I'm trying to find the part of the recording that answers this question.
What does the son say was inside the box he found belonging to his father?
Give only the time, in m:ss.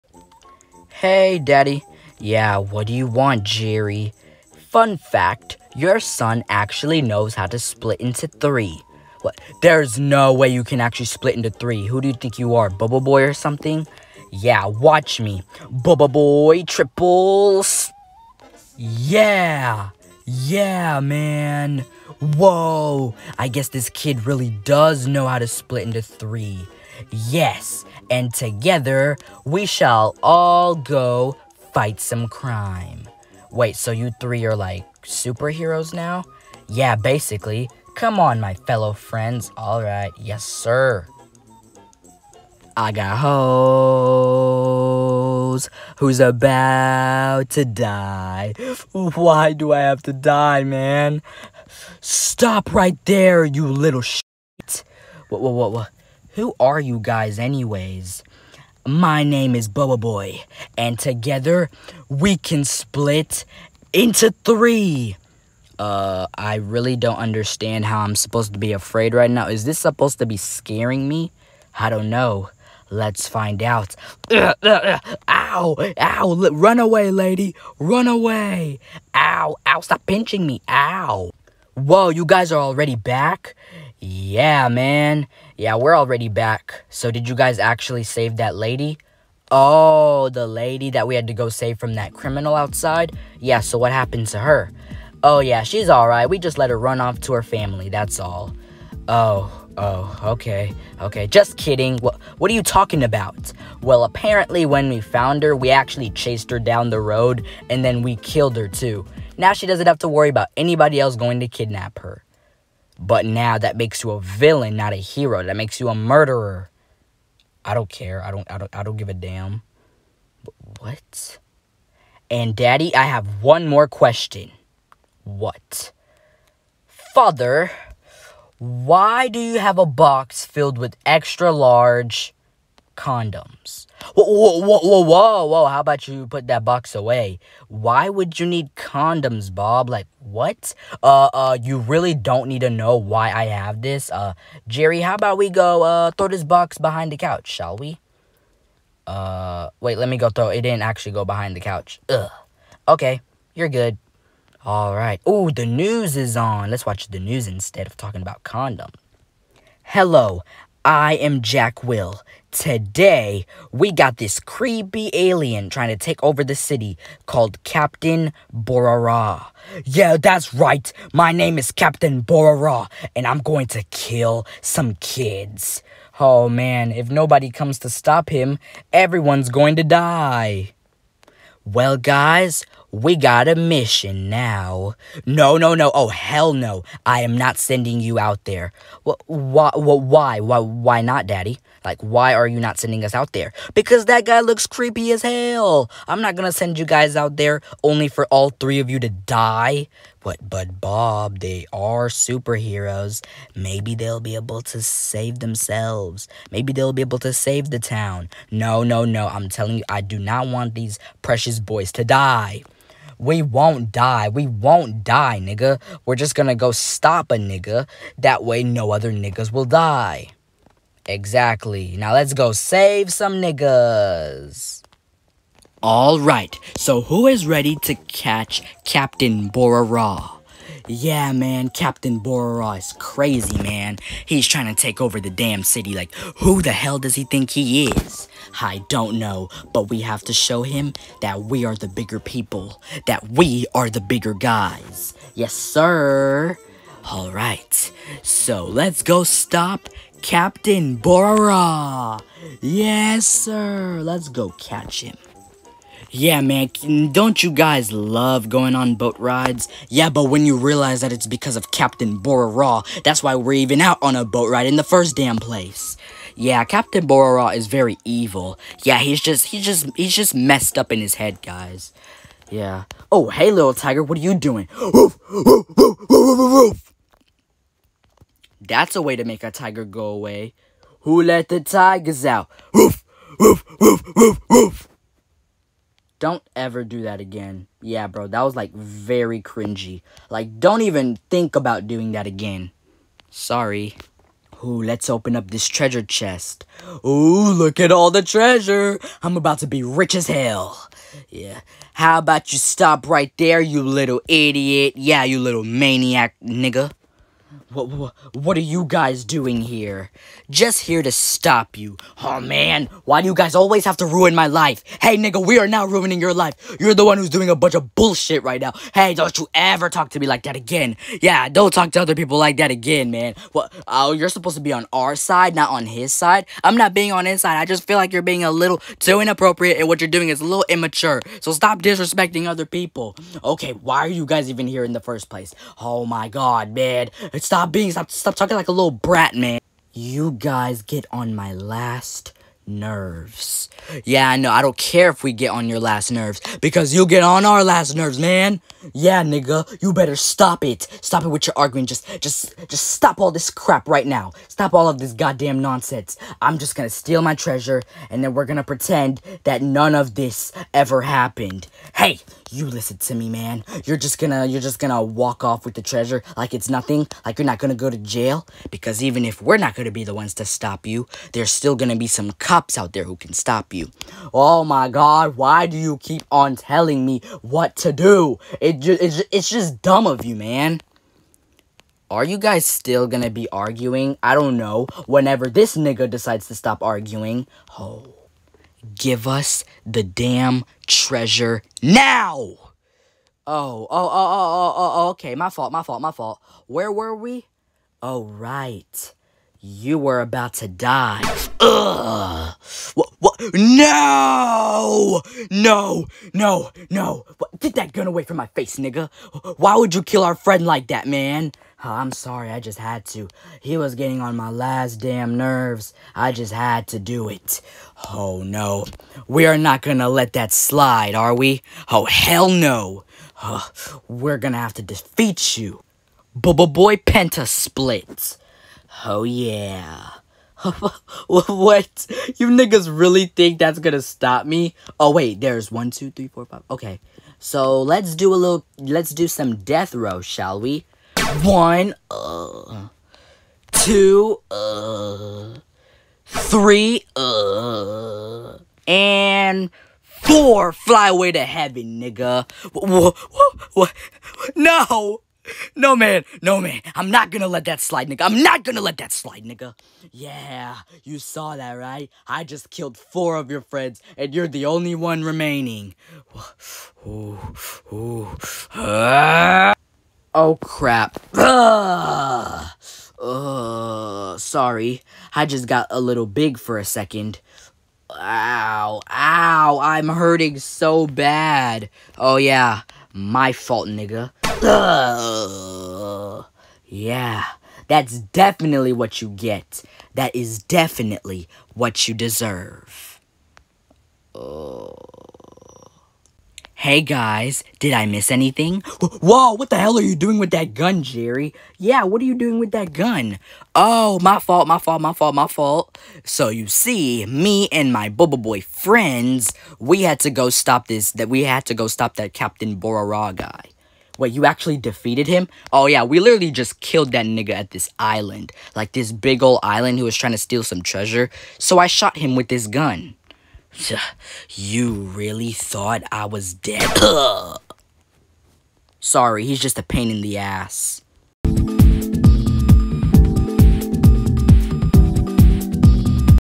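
2:11.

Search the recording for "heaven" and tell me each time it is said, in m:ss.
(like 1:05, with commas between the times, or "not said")
7:31.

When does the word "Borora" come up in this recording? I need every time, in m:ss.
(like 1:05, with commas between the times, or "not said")
3:52, 4:10, 4:22, 4:27.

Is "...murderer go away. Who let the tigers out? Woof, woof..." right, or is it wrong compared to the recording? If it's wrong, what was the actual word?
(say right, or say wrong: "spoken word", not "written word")
wrong: "tiger", not "murderer".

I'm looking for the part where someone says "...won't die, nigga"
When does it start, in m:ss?
3:34.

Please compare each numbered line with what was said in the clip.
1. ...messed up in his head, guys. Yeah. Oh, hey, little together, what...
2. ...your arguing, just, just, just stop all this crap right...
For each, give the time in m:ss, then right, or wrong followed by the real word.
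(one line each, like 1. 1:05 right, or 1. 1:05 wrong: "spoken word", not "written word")
1. 4:30 wrong: "tiger", not "together"
2. 5:51 right.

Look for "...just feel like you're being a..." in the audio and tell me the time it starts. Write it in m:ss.
5:27.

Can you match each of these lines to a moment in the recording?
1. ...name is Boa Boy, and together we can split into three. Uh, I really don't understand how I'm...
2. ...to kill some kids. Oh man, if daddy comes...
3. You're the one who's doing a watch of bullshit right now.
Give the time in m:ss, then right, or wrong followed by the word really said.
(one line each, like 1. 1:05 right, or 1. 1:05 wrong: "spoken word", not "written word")
1. 0:59 right
2. 2:53 wrong: "nobody", not "daddy"
3. 5:16 wrong: "bunch", not "watch".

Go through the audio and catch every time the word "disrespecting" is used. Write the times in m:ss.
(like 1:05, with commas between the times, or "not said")
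5:31.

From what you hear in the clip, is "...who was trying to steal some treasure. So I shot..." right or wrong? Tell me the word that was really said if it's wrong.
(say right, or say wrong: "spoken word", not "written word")
right.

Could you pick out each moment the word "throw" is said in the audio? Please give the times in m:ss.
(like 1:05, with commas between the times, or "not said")
2:26, 2:30.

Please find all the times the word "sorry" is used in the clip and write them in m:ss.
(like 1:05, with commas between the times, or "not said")
4:53, 6:52, 7:54, 8:48.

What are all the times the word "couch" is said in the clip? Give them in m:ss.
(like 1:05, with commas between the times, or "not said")
2:27, 2:31.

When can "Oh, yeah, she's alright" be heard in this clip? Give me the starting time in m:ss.
1:35.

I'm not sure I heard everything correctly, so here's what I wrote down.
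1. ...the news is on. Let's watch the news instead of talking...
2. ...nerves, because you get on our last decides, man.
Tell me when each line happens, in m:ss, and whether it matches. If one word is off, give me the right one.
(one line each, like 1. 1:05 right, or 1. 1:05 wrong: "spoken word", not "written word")
1. 2:35 right
2. 5:46 wrong: "nerves", not "decides".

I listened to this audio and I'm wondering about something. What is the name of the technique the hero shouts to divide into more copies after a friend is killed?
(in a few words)
BoBoiBoy Penta Split.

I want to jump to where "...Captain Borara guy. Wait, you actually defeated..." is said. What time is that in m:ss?
8:32.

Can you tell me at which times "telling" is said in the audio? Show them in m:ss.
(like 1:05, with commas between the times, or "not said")
3:29, 6:16.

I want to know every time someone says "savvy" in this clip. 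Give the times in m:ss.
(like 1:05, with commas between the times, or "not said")
not said.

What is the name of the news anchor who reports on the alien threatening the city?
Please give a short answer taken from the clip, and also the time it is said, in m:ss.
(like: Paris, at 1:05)
Jack Will, at 2:41.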